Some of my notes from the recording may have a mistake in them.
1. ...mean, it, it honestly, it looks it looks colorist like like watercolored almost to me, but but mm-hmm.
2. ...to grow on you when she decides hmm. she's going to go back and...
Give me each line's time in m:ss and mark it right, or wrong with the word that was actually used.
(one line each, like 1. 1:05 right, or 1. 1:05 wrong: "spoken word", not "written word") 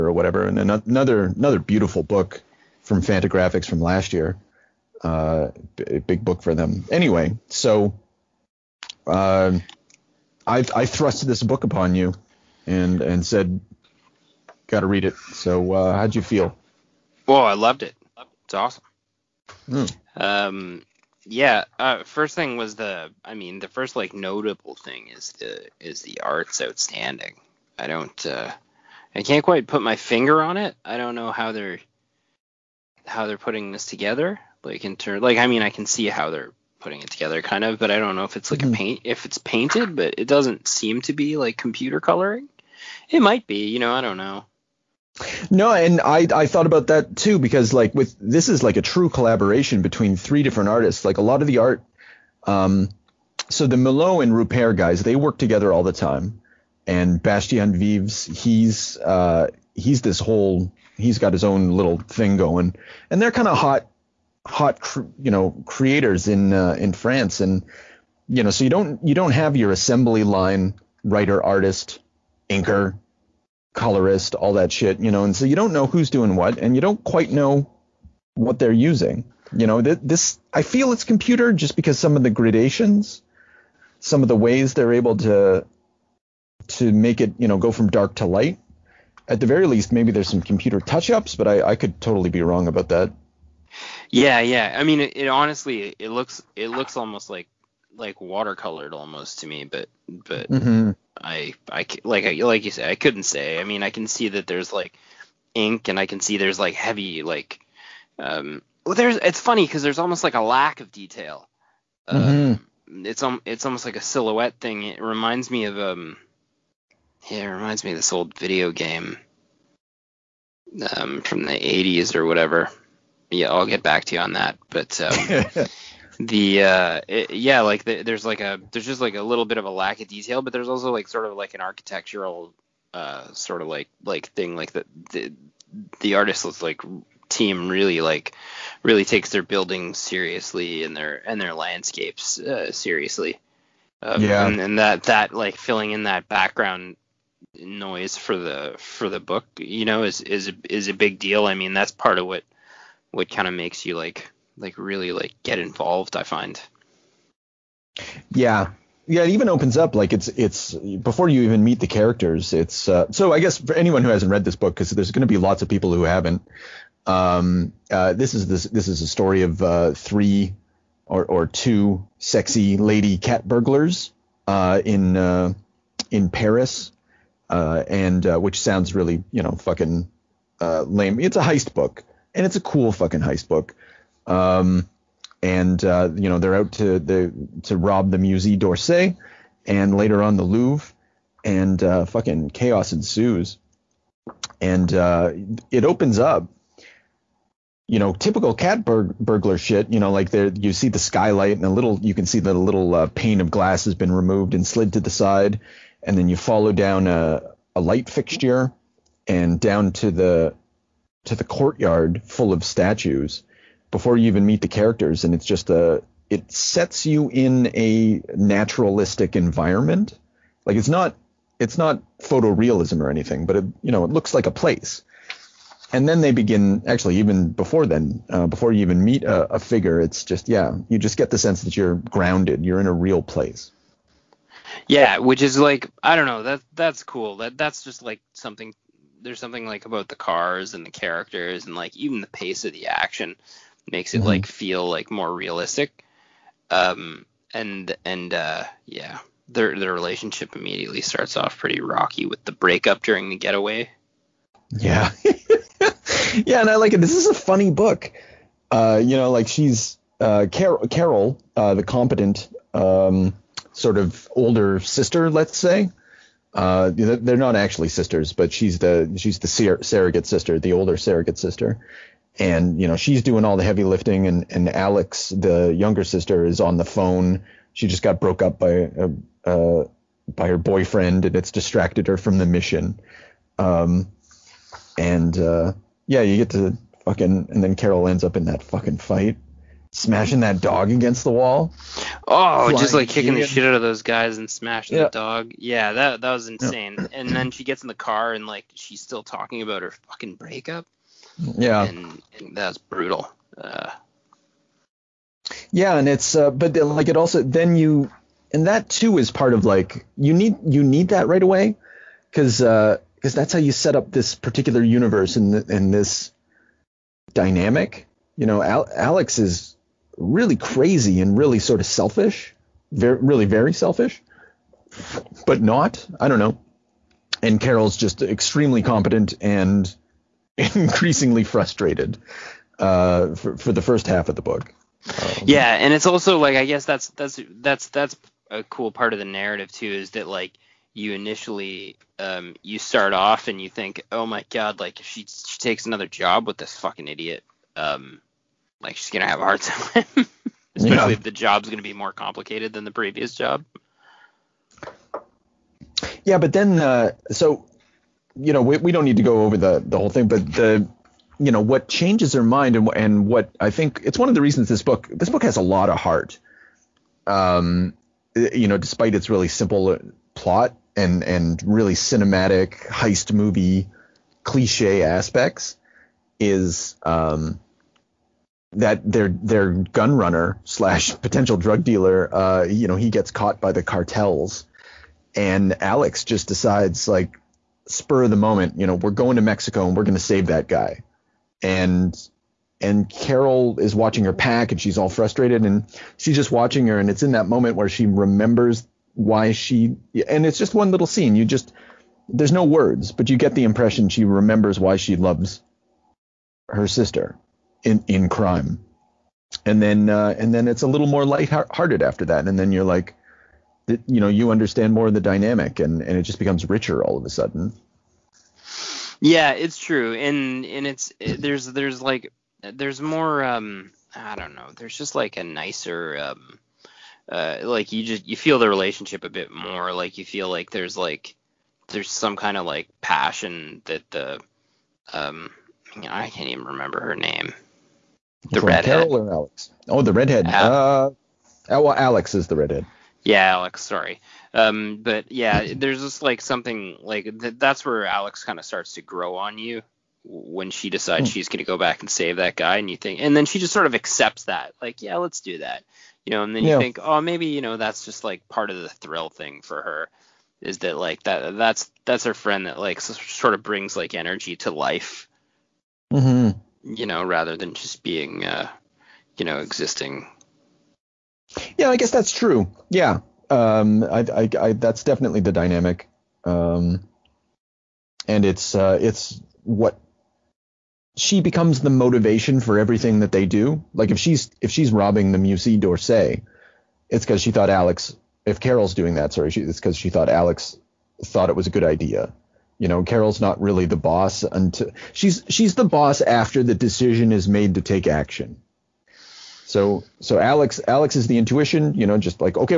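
1. 1:34 wrong: "almost", not "colorist"
2. 7:28 right.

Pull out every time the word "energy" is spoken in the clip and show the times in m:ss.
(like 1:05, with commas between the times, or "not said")
7:44.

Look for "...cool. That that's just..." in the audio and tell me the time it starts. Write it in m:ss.
3:57.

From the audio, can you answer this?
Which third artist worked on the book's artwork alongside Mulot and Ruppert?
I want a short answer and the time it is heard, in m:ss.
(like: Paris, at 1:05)
Bastien Vives, at 0:57.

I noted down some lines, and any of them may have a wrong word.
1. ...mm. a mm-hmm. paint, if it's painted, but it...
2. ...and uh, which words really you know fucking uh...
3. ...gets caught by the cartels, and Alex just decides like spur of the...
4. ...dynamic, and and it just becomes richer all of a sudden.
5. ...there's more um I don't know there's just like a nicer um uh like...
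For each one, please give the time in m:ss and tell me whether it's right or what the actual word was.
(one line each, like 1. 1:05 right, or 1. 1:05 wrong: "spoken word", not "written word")
1. 0:38 right
2. 2:57 wrong: "sounds", not "words"
3. 6:23 right
4. 6:55 right
5. 7:02 right.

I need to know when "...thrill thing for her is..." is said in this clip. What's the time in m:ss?
7:38.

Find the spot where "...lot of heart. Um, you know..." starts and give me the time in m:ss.
6:05.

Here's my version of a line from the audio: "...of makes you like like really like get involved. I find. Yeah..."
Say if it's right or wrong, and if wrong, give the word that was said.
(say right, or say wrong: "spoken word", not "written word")
right.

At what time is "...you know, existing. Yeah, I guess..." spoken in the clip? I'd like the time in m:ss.
7:49.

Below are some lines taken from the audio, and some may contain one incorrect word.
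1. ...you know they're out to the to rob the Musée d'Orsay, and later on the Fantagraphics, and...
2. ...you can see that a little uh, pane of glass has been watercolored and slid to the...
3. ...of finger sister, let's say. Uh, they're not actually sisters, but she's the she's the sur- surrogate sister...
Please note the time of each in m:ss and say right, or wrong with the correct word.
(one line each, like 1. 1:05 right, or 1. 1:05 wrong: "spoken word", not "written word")
1. 3:06 wrong: "Louvre", not "Fantagraphics"
2. 3:22 wrong: "removed", not "watercolored"
3. 4:23 wrong: "older", not "finger".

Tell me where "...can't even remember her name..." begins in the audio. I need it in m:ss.
7:16.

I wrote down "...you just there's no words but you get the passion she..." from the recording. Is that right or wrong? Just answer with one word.
wrong.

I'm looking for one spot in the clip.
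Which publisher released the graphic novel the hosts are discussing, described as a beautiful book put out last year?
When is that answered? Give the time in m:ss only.
0:03.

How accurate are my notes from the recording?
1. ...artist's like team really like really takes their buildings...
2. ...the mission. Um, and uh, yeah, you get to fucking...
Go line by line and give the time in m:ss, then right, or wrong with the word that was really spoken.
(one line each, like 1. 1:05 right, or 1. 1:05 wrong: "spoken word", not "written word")
1. 2:16 right
2. 4:42 right.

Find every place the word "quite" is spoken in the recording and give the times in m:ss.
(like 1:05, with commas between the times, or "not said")
0:29, 1:17.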